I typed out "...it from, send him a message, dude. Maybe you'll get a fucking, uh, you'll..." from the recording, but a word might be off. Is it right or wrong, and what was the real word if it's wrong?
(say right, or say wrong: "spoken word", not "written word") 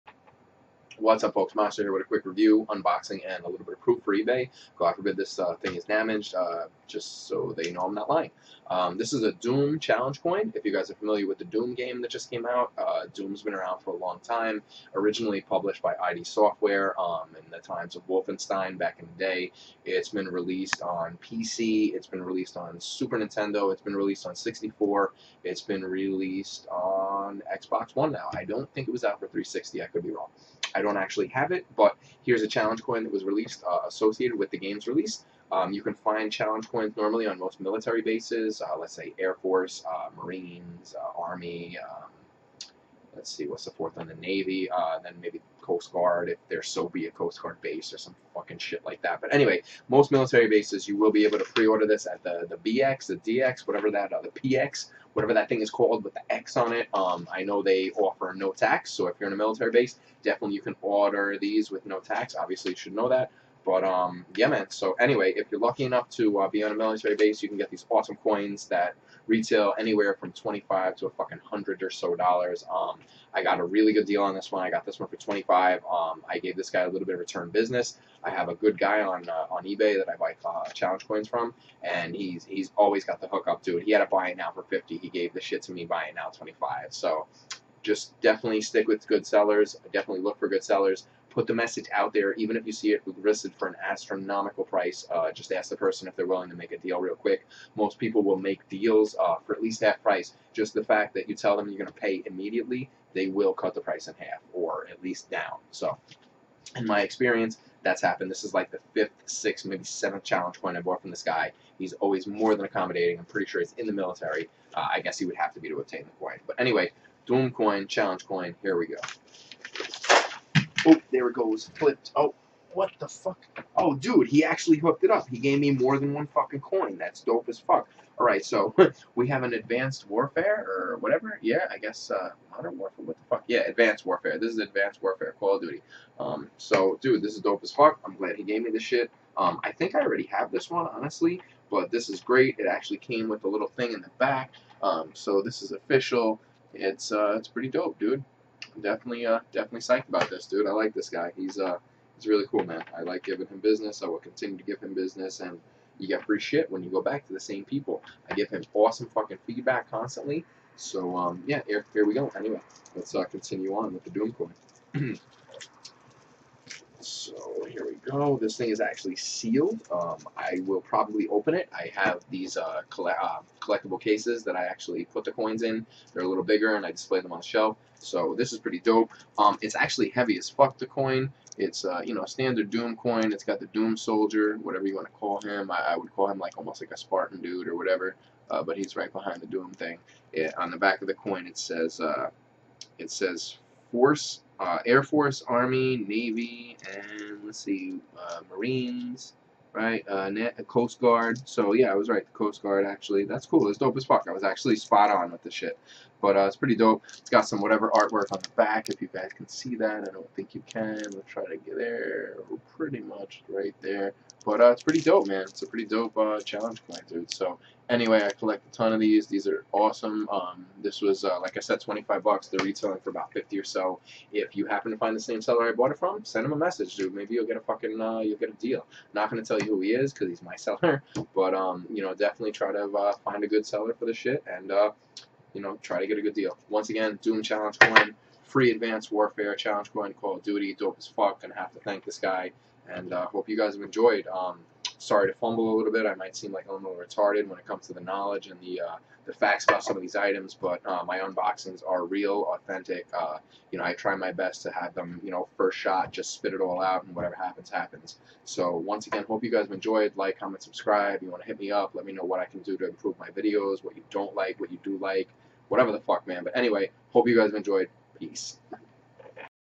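right.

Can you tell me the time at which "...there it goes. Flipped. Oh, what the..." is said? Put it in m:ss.
2:01.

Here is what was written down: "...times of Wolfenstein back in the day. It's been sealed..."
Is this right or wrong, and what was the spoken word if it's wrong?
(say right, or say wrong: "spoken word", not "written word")
wrong: "released", not "sealed".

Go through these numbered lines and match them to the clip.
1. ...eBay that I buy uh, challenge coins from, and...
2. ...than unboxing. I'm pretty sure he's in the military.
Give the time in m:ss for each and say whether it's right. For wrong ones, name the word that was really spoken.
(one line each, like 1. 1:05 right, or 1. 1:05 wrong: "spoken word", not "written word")
1. 1:19 right
2. 1:52 wrong: "accommodating", not "unboxing".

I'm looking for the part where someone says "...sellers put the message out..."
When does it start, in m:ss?
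1:30.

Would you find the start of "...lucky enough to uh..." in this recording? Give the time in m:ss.
1:05.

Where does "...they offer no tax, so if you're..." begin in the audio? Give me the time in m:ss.
0:57.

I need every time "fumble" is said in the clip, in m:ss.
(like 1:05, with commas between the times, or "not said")
4:05.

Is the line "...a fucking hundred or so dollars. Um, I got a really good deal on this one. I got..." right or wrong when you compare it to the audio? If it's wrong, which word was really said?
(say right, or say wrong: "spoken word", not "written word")
right.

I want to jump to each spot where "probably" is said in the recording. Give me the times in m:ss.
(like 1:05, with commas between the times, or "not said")
2:50.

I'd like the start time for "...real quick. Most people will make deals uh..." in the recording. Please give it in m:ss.
1:36.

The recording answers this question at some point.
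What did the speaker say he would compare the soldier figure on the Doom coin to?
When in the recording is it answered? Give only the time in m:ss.
3:06.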